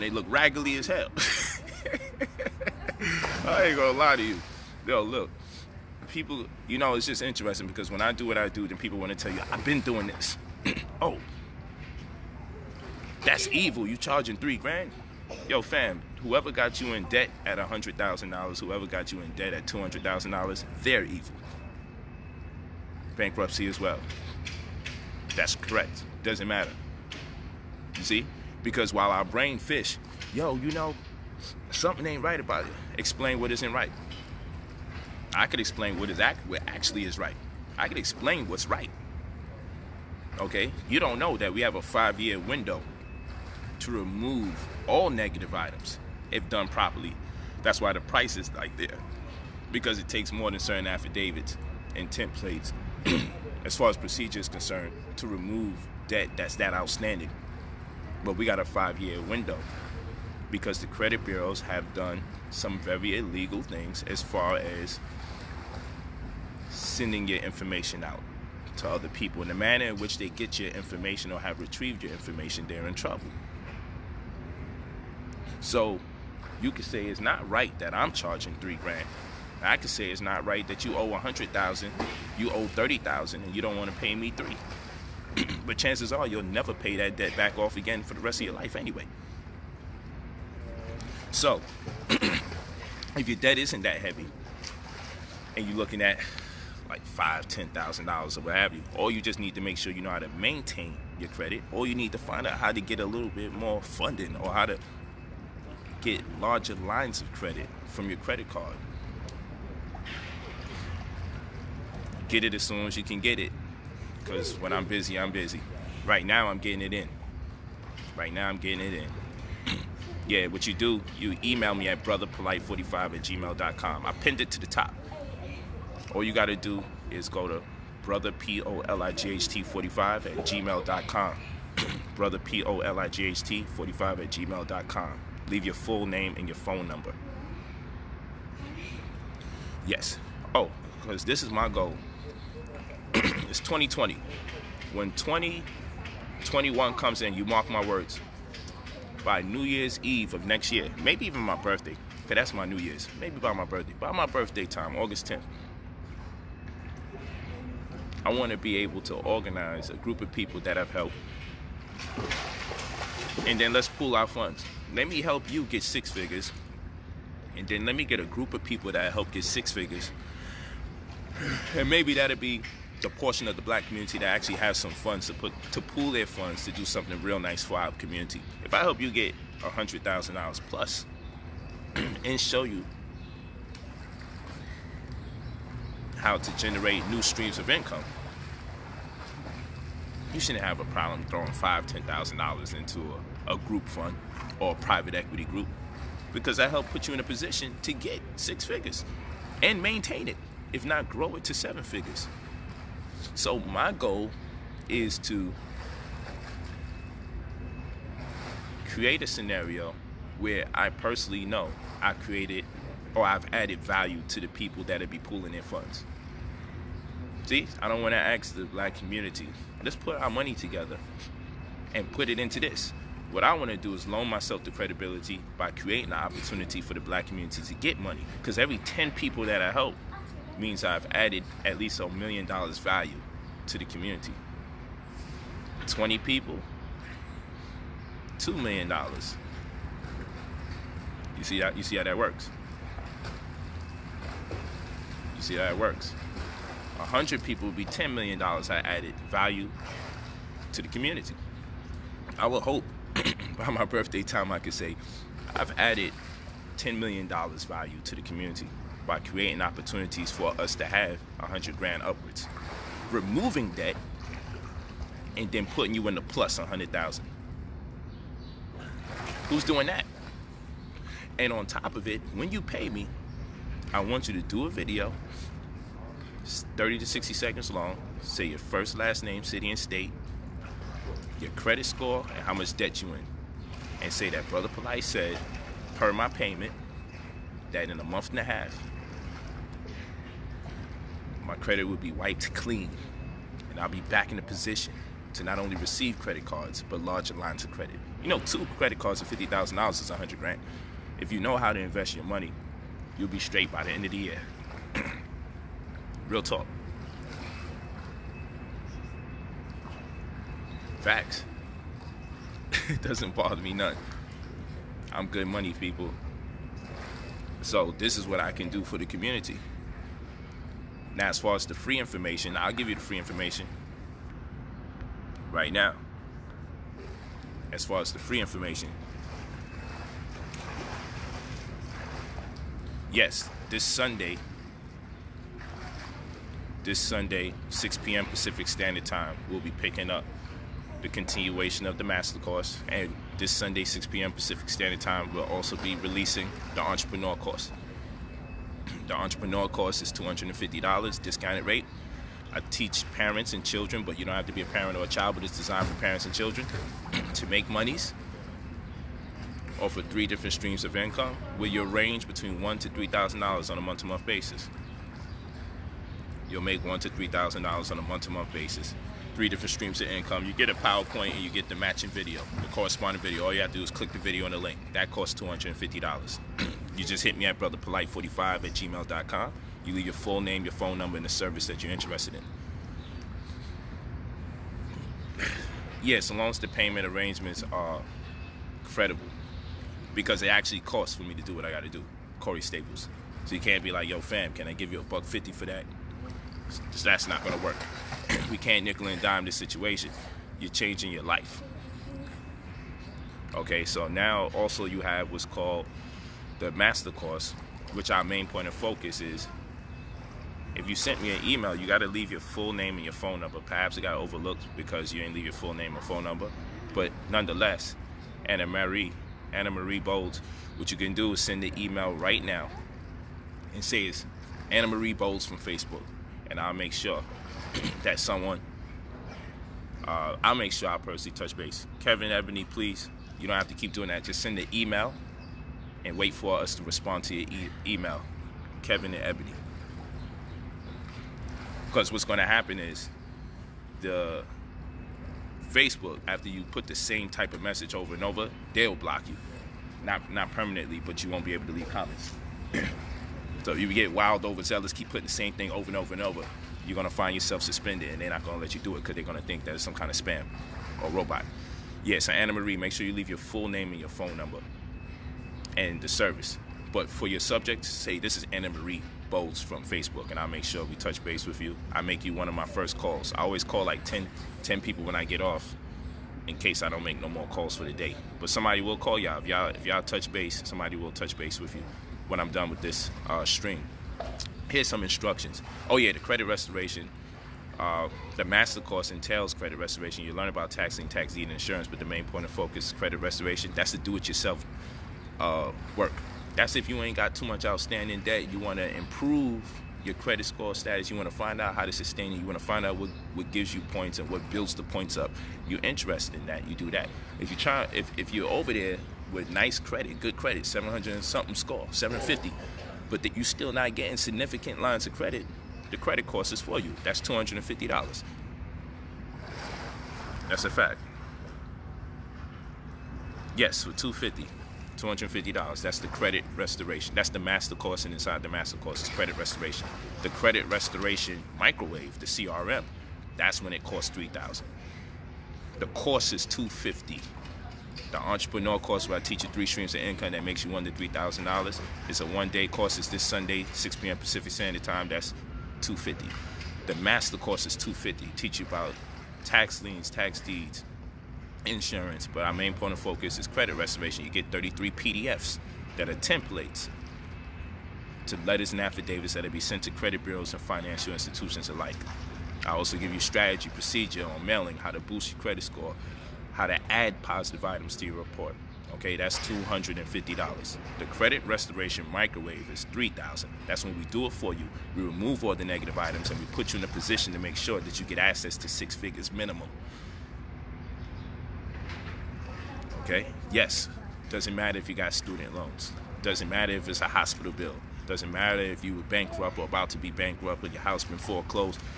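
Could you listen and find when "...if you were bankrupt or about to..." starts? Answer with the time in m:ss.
9:48.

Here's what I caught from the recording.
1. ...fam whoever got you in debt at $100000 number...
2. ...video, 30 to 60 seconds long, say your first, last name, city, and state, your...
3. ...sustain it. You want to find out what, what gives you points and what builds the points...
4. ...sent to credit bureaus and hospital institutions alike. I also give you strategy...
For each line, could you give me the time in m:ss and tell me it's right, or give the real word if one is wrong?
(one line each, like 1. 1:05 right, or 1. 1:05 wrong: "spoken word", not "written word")
1. 0:15 wrong: "whoever", not "number"
2. 4:34 right
3. 8:21 right
4. 9:19 wrong: "financial", not "hospital".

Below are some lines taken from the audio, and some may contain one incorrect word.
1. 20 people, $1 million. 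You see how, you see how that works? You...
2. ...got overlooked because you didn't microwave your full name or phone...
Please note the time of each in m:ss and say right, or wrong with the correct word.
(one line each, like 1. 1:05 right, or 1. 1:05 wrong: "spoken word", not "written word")
1. 3:55 wrong: "2", not "1"
2. 6:53 wrong: "leave", not "microwave".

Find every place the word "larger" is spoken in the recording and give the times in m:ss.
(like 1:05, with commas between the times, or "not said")
1:46, 4:57.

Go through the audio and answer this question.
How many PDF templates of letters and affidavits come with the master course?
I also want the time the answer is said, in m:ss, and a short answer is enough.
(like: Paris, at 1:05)
33, at 9:14.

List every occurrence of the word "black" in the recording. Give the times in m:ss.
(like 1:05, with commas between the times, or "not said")
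2:53, 3:38, 3:46.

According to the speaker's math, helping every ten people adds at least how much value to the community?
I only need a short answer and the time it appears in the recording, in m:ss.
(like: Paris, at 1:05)
$1 million, at 3:51.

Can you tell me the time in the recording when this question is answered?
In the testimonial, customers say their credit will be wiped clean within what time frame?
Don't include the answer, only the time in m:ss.
4:47.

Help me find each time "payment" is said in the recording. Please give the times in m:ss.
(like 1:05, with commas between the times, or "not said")
4:46, 6:26.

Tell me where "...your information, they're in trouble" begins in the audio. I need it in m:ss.
1:12.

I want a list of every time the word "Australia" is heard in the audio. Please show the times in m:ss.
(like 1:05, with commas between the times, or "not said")
not said.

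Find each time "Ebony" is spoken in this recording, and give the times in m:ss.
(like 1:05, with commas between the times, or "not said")
7:12, 7:19.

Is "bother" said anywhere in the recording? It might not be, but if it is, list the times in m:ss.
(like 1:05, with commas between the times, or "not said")
5:13.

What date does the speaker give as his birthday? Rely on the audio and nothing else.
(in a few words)
August 10th.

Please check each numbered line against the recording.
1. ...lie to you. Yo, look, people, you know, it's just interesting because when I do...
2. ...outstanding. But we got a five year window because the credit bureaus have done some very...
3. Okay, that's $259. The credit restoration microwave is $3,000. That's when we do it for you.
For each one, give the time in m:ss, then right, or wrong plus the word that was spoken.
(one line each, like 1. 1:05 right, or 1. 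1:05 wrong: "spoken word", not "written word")
1. 0:03 right
2. 0:56 right
3. 9:28 wrong: "250", not "259".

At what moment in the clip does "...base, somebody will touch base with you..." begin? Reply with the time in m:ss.
8:00.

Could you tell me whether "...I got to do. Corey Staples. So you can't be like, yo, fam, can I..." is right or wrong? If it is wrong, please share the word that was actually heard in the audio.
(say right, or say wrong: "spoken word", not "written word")
right.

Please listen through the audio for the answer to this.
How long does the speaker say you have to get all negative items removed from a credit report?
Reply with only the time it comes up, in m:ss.
0:41.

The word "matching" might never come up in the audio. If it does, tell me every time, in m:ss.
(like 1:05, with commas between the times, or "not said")
6:11.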